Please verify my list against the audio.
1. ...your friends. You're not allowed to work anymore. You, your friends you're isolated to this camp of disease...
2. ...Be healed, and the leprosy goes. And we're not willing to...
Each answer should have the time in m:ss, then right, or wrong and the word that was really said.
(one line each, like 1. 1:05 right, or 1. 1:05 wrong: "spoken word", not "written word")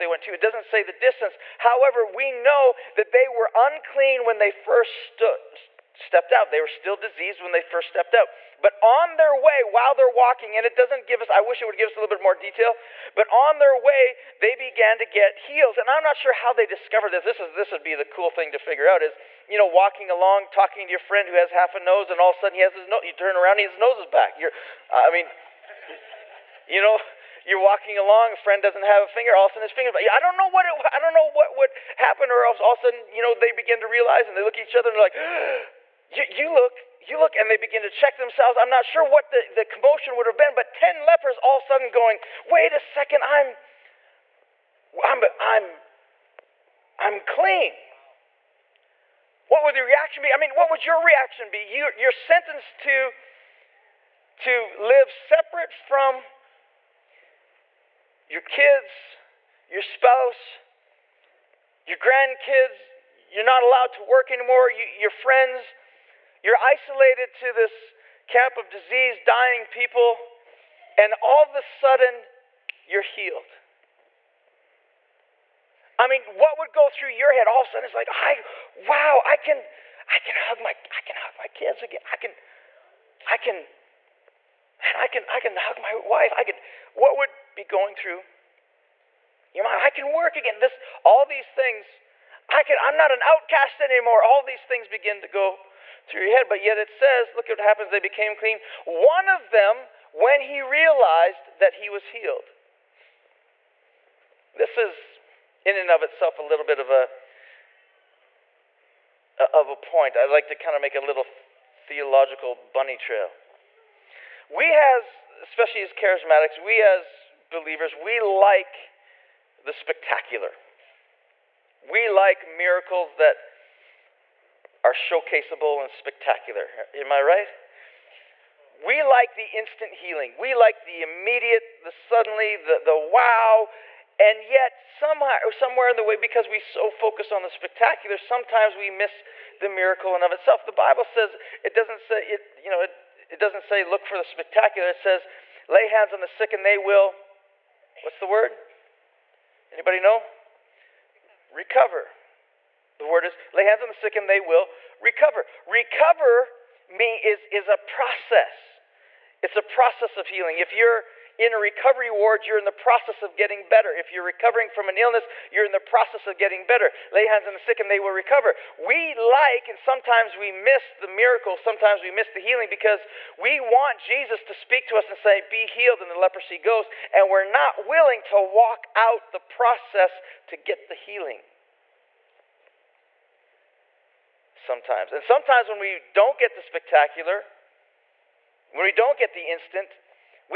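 1. 1:01 wrong: "grandkids", not "friends"
2. 2:55 right.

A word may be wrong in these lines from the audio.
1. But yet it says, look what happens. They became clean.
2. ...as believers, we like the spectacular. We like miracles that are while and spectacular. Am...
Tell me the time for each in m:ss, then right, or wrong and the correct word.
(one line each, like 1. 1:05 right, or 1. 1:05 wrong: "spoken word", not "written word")
1. 1:36 right
2. 1:56 wrong: "showcaseable", not "while".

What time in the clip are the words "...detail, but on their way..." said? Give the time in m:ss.
0:12.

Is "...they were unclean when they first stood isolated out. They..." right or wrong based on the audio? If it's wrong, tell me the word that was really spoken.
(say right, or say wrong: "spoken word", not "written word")
wrong: "stepped", not "isolated".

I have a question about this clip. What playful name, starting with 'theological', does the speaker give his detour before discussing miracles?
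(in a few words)
bunny trail.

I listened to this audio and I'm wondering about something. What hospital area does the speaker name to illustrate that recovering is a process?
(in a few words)
recovery ward.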